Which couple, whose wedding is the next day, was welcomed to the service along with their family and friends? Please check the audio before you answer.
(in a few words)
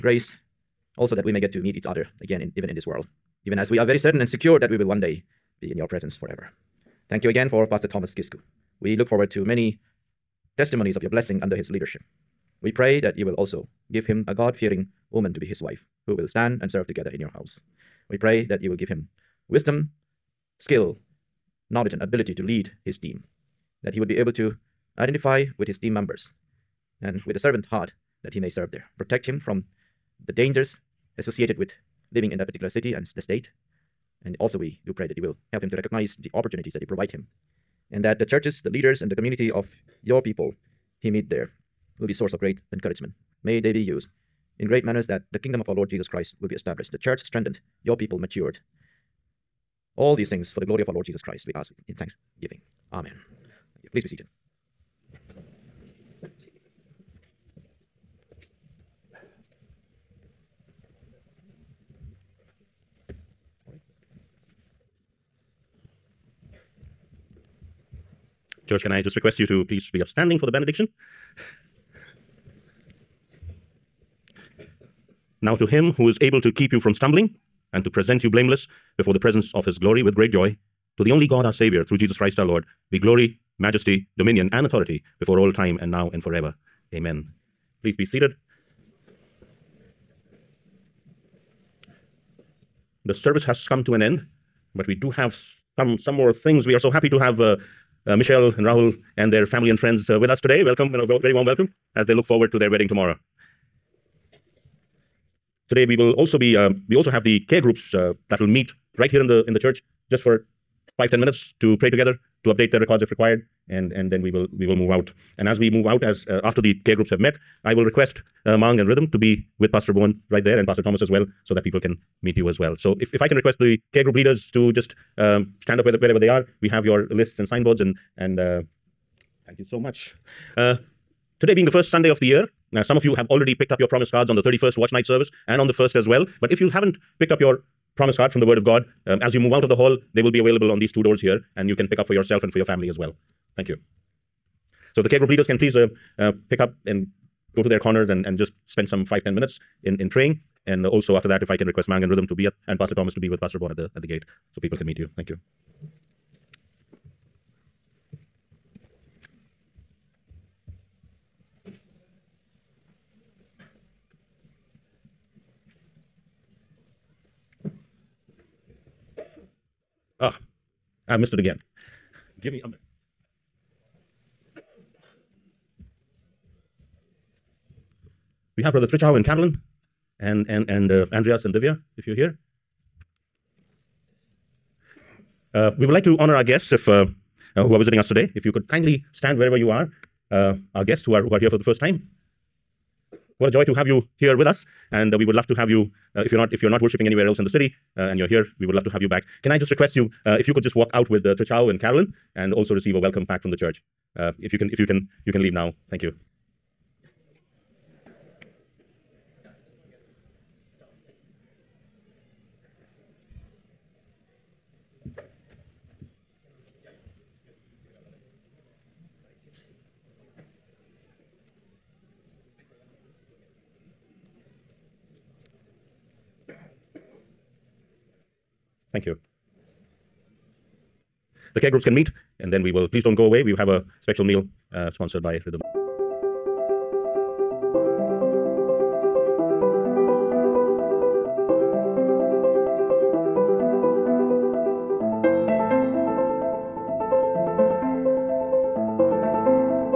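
Michelle and Rahul.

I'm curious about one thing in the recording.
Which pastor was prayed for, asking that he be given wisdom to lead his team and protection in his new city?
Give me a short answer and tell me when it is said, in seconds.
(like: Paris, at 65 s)
Pastor Thomas Gisku, at 7 s.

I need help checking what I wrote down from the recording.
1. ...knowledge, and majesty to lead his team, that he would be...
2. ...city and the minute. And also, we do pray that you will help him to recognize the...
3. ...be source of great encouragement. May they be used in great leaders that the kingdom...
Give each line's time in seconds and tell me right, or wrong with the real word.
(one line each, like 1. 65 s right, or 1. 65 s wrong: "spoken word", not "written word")
1. 21 s wrong: "ability", not "majesty"
2. 32 s wrong: "state", not "minute"
3. 42 s wrong: "manners", not "leaders".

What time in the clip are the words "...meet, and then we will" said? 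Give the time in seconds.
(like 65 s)
231 s.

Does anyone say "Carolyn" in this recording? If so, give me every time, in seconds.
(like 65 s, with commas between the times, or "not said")
179 s, 201 s.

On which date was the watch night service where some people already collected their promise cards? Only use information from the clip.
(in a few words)
31st.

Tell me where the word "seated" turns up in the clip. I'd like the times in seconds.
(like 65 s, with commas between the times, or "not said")
54 s, 88 s.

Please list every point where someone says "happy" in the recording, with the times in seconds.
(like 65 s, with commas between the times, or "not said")
96 s.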